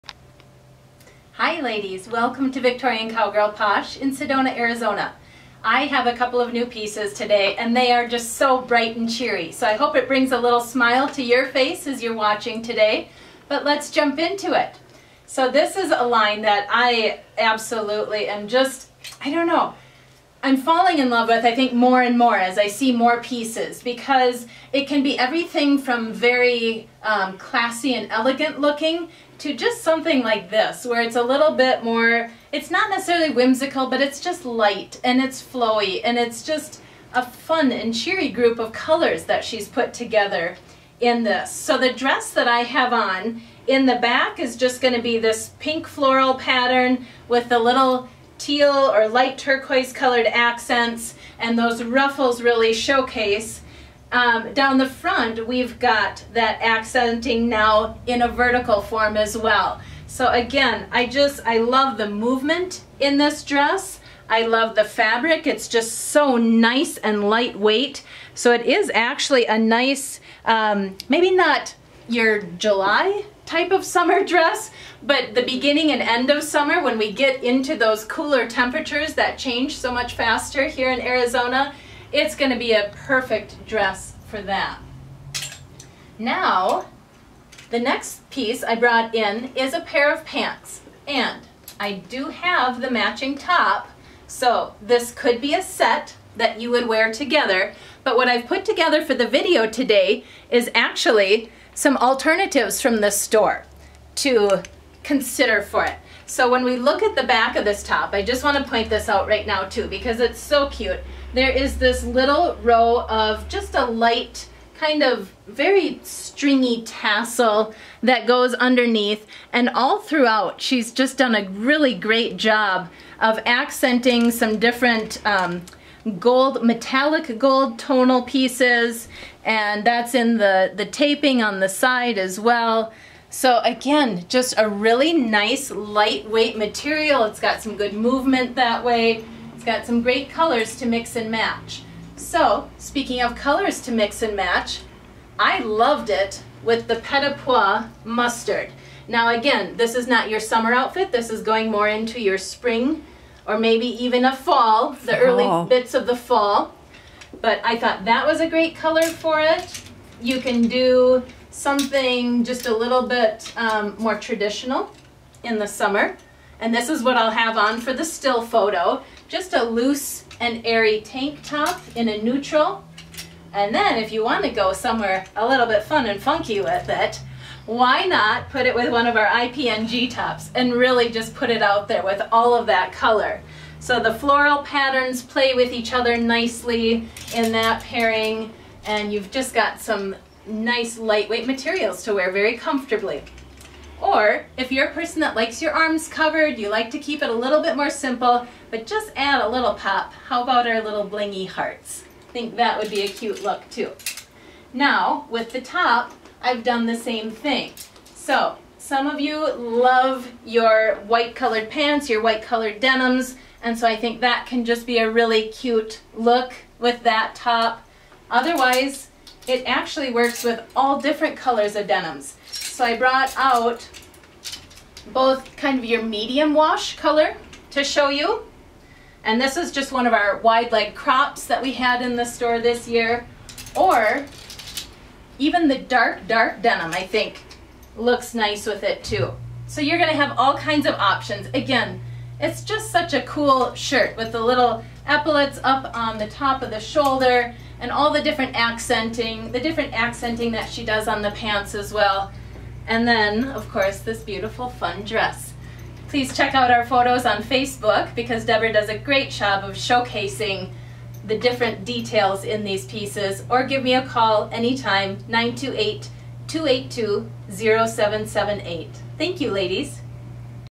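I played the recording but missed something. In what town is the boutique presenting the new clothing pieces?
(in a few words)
Sedona.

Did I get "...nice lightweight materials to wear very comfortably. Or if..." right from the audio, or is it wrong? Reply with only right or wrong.
right.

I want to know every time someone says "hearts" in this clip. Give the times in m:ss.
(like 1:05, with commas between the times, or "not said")
3:21.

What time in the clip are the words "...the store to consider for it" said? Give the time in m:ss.
1:43.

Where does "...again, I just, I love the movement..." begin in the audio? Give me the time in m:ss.
1:00.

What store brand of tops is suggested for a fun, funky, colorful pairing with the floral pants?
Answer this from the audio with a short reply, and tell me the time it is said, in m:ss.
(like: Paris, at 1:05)
IPNG, at 2:59.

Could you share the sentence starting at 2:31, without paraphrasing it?
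This is going more into your spring or maybe even a fall, the fall.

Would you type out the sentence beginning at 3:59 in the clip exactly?
So you're gonna have all kinds of options.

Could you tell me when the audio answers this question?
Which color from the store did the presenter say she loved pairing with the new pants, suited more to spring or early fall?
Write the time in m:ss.
2:26.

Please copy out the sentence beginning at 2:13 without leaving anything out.
So again, just a really nice lightweight material.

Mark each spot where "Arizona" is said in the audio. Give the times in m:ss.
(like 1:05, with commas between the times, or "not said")
0:04, 1:21.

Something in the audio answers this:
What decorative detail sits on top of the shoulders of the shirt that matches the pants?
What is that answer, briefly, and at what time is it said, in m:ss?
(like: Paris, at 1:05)
Epaulets, at 4:05.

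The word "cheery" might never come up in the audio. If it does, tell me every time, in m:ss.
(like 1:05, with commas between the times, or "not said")
0:09, 0:37.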